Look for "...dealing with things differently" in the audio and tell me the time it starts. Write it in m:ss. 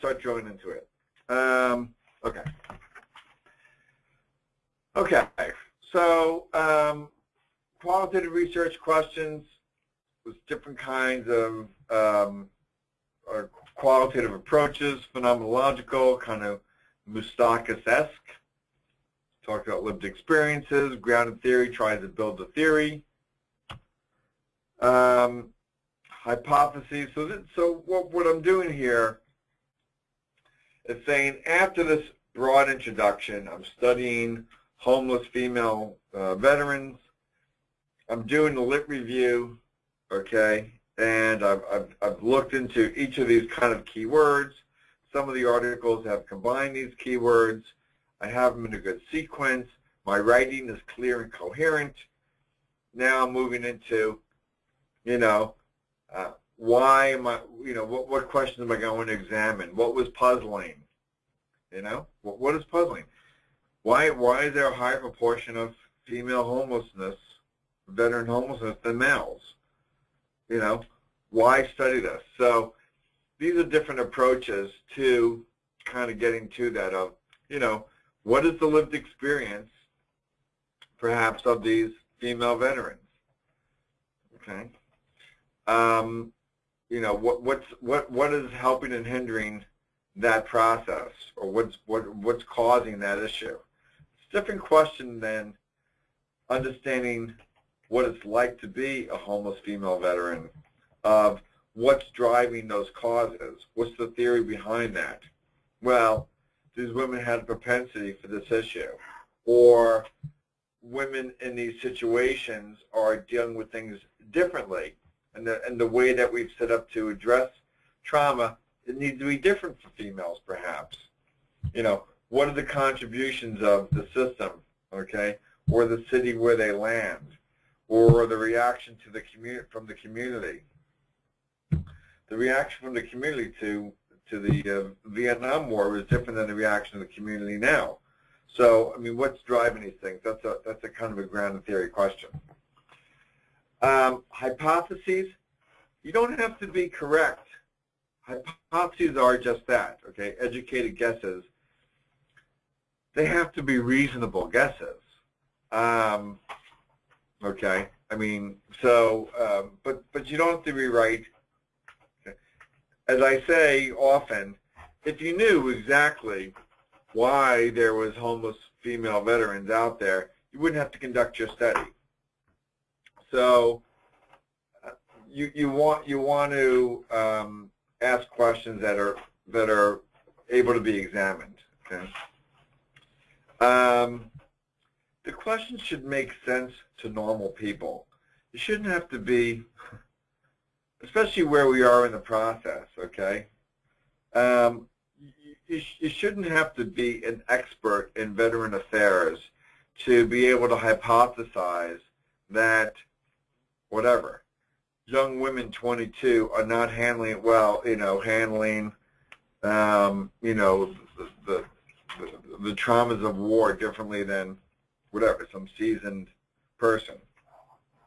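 1:53.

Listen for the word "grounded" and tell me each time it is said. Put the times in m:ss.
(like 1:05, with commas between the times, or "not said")
0:21, 2:21.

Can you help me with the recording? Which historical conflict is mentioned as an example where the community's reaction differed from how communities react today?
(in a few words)
Vietnam War.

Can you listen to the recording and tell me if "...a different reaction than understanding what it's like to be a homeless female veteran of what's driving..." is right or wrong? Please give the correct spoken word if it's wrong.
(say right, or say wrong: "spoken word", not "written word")
wrong: "question", not "reaction".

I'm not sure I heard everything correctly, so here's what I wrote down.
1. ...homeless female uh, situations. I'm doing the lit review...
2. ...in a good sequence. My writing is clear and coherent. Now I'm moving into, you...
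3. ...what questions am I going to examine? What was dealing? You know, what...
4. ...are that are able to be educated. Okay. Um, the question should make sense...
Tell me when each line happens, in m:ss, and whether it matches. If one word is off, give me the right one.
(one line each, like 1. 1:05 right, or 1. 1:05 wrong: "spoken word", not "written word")
1. 0:34 wrong: "veterans", not "situations"
2. 0:48 right
3. 0:58 wrong: "puzzling", not "dealing"
4. 2:58 wrong: "examined", not "educated".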